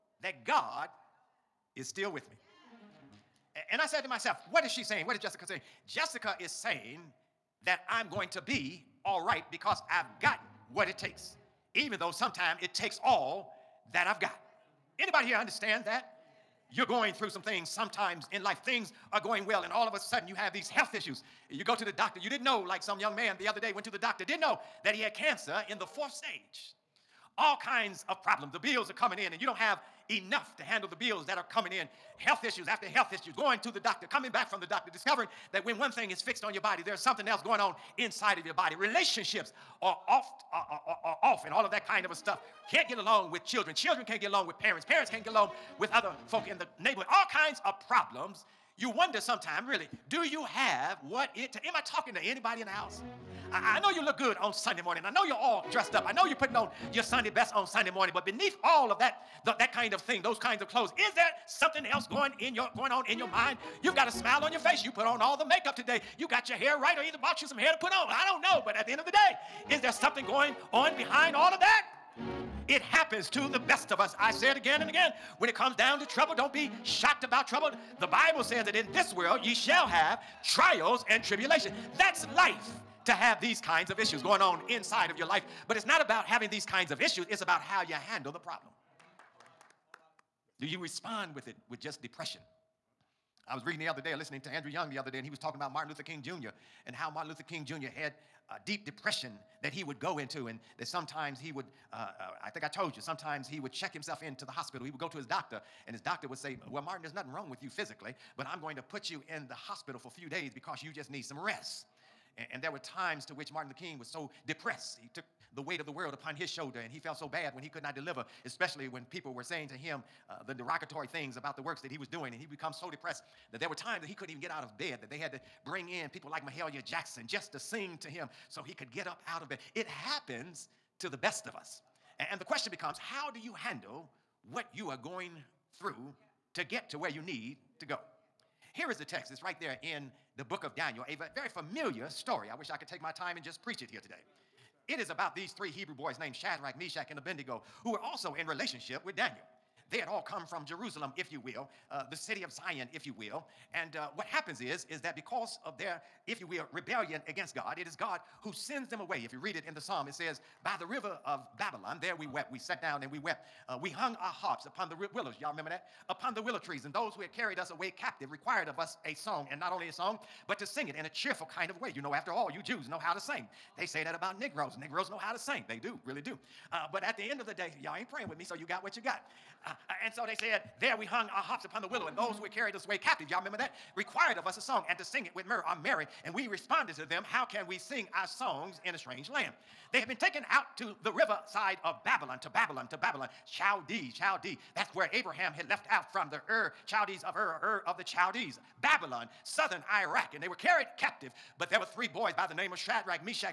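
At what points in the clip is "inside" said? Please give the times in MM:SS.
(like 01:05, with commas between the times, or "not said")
00:37, 01:24.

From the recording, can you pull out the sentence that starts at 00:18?
Things are going well, and all of a sudden you have these health issues.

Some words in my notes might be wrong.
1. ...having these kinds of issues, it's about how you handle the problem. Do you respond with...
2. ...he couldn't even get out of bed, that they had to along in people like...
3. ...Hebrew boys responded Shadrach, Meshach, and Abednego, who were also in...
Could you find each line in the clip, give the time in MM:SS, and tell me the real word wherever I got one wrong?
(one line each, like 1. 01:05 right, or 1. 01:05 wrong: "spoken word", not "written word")
1. 01:26 right
2. 02:04 wrong: "bring", not "along"
3. 02:25 wrong: "named", not "responded".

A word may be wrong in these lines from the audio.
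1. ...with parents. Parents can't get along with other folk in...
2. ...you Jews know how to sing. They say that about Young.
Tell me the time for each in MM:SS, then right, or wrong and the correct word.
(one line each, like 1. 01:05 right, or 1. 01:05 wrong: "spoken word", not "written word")
1. 00:44 right
2. 02:52 wrong: "Negroes", not "Young".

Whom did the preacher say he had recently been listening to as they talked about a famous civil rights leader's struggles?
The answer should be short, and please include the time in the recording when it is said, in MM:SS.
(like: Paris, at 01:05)
Andrew Young, at 01:34.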